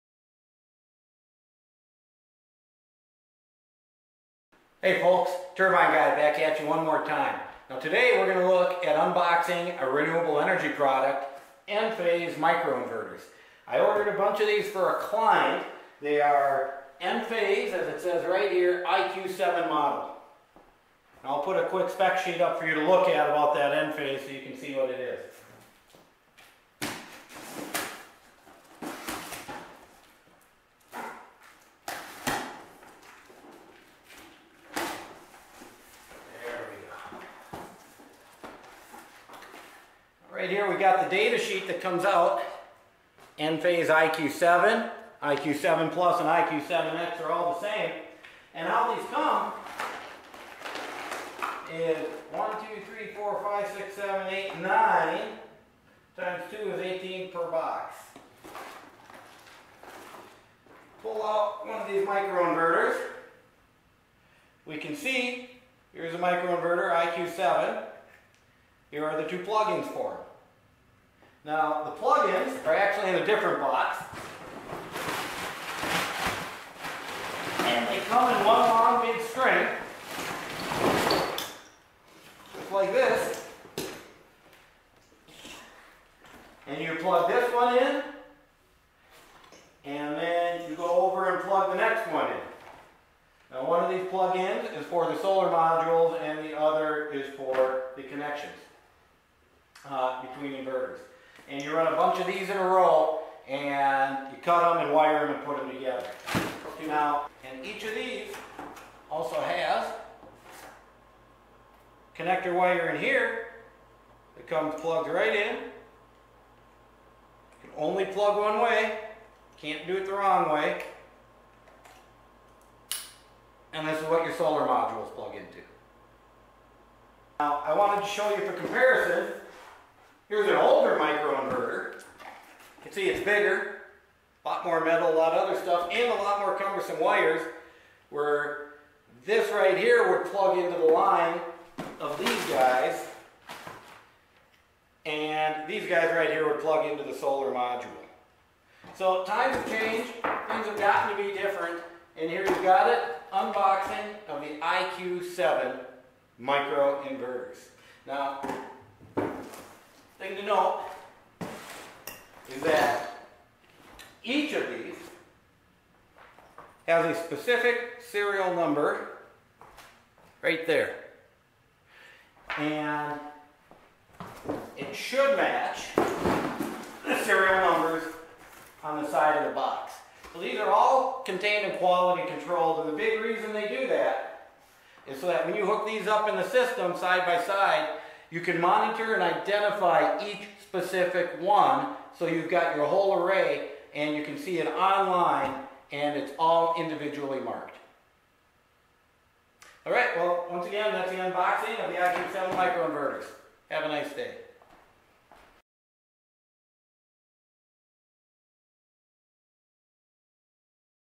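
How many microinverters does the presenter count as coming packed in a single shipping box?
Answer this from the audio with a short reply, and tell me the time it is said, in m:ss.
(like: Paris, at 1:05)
18, at 0:56.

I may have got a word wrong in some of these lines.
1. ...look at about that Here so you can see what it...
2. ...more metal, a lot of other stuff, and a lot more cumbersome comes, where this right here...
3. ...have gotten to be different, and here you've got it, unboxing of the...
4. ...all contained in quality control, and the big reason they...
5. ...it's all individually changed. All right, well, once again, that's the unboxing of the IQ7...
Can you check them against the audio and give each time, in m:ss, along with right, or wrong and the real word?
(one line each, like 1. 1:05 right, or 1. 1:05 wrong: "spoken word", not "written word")
1. 0:22 wrong: "Enphase", not "Here"
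2. 2:14 wrong: "wires", not "comes"
3. 2:30 right
4. 3:00 right
5. 3:16 wrong: "marked", not "changed".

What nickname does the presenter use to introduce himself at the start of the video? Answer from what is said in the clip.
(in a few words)
Turbine Guy.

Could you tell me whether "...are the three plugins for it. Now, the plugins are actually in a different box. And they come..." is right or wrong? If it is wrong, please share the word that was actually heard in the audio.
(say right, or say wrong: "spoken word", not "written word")
wrong: "two", not "three".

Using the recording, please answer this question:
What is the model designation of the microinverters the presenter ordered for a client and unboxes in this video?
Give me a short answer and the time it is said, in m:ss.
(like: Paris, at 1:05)
IQ7, at 0:18.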